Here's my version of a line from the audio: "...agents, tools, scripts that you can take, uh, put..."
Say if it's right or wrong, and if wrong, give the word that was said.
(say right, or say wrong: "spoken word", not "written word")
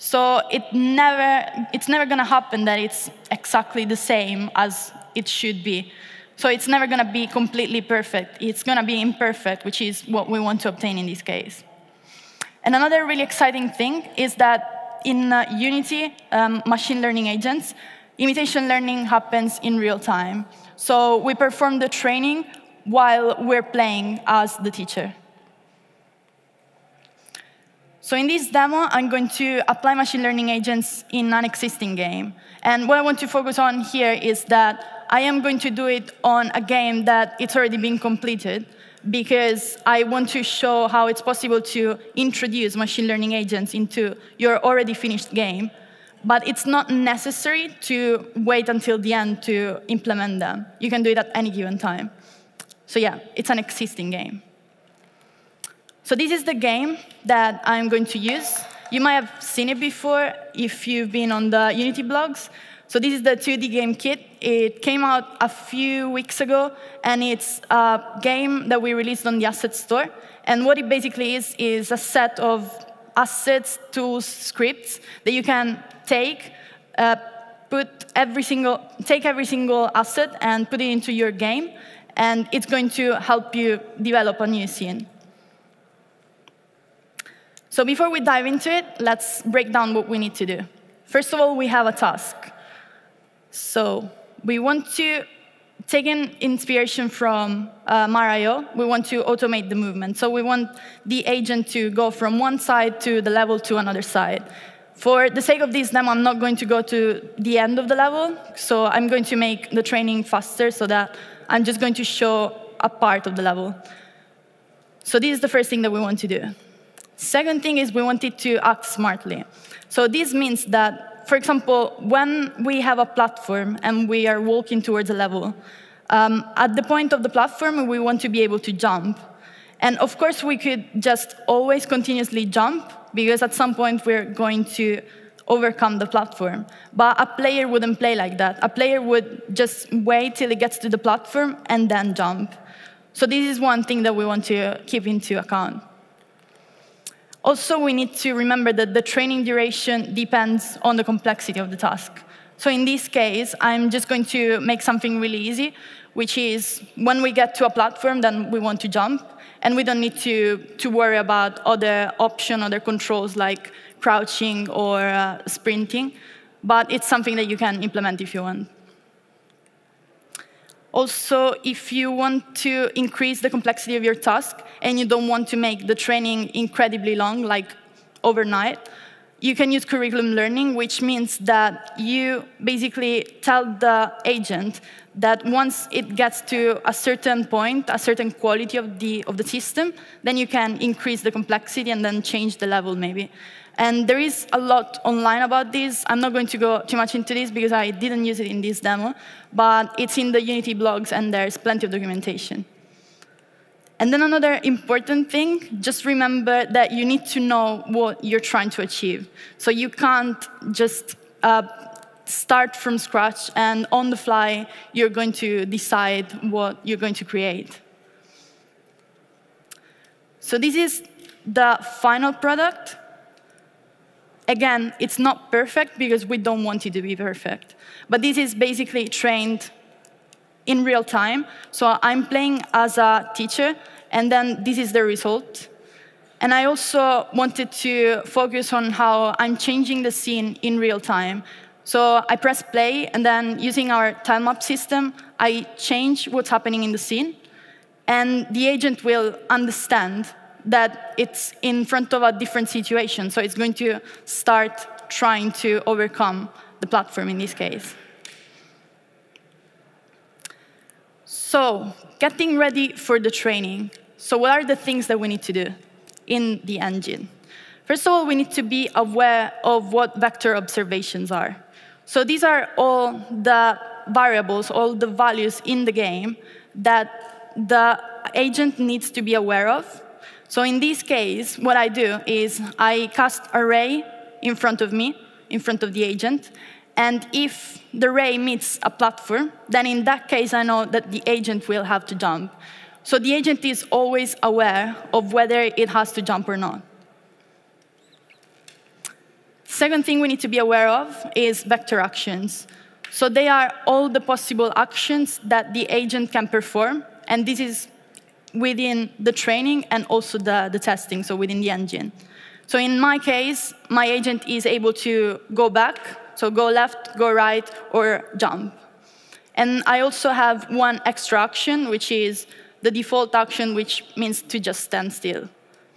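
wrong: "assets", not "agents".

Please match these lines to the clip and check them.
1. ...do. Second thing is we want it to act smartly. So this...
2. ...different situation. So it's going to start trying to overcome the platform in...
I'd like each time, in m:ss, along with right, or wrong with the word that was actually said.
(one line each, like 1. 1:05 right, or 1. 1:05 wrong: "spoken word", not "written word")
1. 1:56 right
2. 4:12 right.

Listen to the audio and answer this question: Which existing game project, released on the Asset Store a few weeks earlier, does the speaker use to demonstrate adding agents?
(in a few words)
2D game kit.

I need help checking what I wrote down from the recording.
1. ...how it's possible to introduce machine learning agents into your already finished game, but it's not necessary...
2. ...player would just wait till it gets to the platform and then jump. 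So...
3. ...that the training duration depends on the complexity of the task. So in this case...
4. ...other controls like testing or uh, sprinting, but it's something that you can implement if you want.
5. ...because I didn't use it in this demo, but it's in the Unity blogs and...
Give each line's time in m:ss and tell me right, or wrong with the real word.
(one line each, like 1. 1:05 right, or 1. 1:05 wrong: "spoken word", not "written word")
1. 0:40 right
2. 2:18 right
3. 2:28 right
4. 2:42 wrong: "crouching", not "testing"
5. 3:17 right.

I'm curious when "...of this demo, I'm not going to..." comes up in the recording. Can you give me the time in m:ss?
1:45.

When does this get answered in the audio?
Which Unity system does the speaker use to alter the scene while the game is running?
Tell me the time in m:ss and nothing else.
4:04.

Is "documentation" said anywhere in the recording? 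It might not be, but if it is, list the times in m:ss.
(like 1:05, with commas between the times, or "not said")
3:21.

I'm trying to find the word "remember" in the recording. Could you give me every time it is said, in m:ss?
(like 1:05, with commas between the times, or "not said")
2:28, 3:26.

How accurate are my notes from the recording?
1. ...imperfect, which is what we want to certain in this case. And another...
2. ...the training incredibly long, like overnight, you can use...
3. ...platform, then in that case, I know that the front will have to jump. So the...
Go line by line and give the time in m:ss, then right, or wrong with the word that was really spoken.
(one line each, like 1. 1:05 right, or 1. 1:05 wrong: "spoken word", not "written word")
1. 0:09 wrong: "obtain", not "certain"
2. 2:55 right
3. 4:48 wrong: "agent", not "front".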